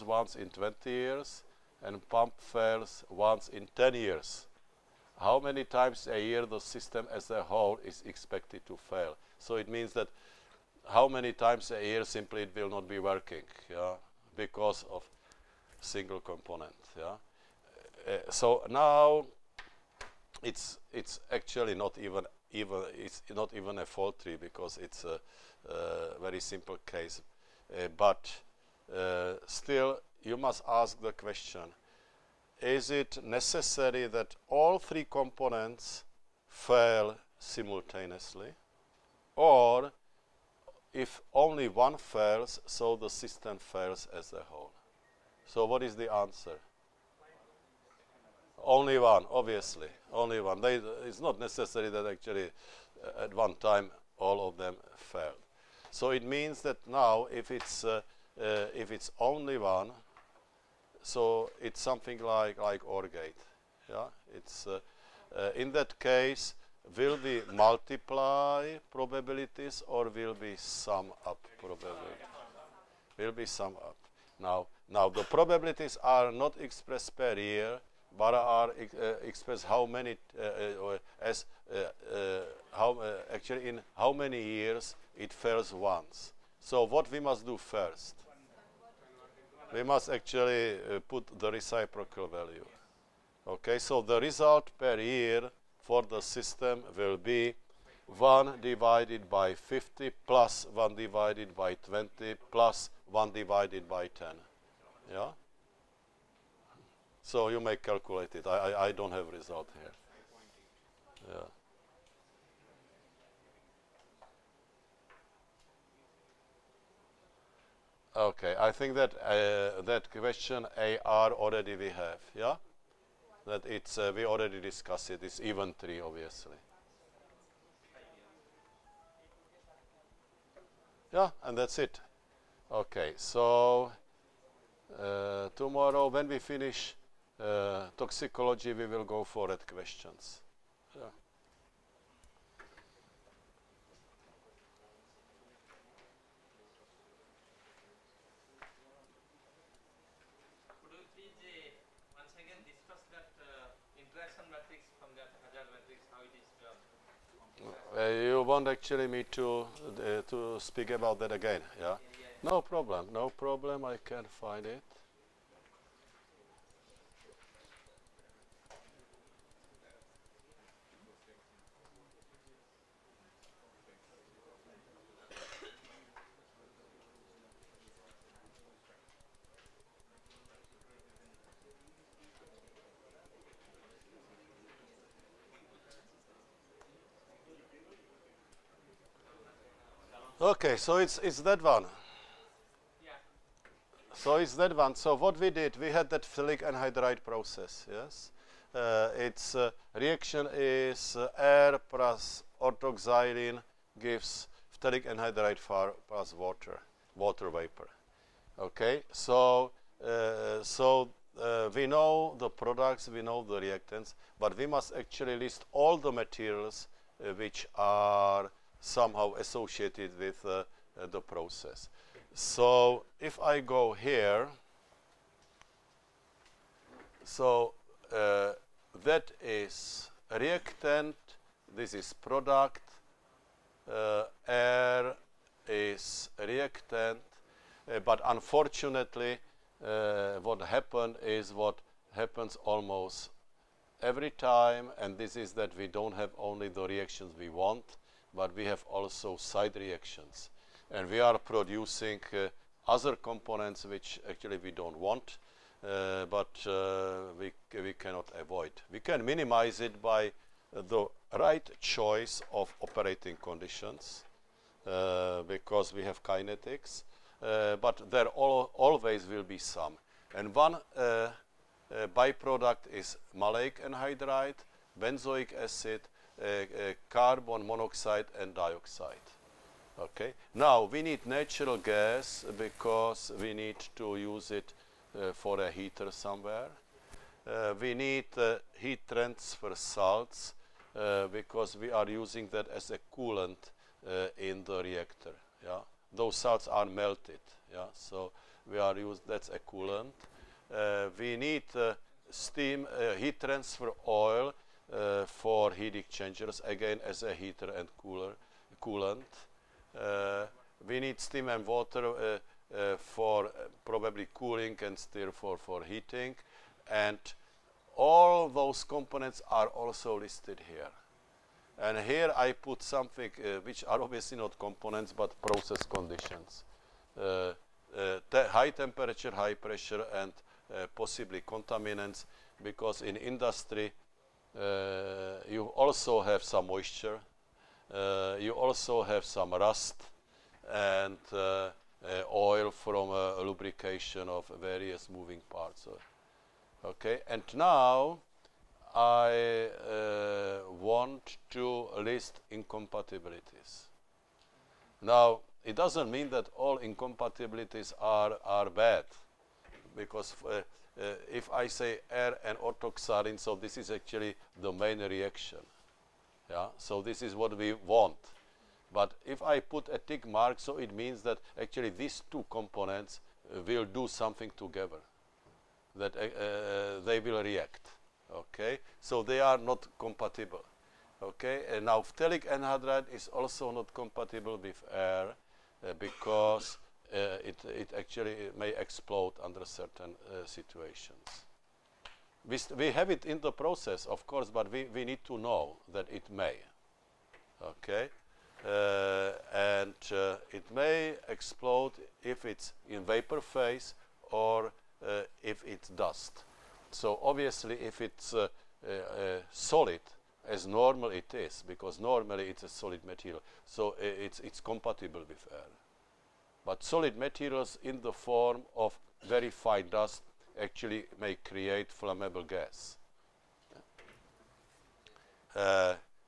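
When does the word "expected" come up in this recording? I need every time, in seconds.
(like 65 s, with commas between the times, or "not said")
8 s.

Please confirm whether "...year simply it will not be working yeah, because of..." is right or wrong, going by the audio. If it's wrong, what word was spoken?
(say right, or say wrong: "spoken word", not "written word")
right.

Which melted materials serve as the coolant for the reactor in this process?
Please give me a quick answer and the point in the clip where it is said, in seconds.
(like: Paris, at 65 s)
heat transfer salts, at 288 s.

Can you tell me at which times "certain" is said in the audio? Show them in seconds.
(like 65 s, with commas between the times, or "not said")
389 s.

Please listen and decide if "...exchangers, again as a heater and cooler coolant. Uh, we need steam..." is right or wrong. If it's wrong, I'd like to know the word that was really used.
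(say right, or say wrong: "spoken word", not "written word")
right.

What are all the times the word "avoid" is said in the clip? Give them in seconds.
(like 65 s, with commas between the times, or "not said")
258 s.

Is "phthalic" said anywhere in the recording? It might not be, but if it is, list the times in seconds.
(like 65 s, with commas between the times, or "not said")
196 s, 204 s, 382 s.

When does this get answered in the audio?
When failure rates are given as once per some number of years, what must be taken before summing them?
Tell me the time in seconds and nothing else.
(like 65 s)
91 s.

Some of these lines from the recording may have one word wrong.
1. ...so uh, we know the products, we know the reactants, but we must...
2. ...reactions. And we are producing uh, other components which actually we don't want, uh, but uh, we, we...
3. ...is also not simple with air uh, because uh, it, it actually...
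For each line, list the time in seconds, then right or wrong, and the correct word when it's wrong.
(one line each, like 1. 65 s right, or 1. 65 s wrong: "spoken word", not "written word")
1. 210 s right
2. 249 s right
3. 383 s wrong: "compatible", not "simple".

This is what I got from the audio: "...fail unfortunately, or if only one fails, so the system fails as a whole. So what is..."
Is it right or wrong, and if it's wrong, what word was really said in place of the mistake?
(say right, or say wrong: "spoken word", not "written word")
wrong: "simultaneously", not "unfortunately".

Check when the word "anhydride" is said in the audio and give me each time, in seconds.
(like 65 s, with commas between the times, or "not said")
196 s, 205 s, 273 s, 382 s.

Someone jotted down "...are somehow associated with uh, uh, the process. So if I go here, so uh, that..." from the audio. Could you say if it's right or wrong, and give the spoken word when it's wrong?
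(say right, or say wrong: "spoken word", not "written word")
right.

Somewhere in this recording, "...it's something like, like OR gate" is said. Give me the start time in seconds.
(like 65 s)
61 s.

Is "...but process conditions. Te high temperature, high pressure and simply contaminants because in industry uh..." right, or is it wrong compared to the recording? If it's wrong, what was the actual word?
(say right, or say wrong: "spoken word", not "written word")
wrong: "possibly", not "simply".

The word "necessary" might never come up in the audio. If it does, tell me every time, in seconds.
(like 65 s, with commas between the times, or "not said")
33 s, 51 s.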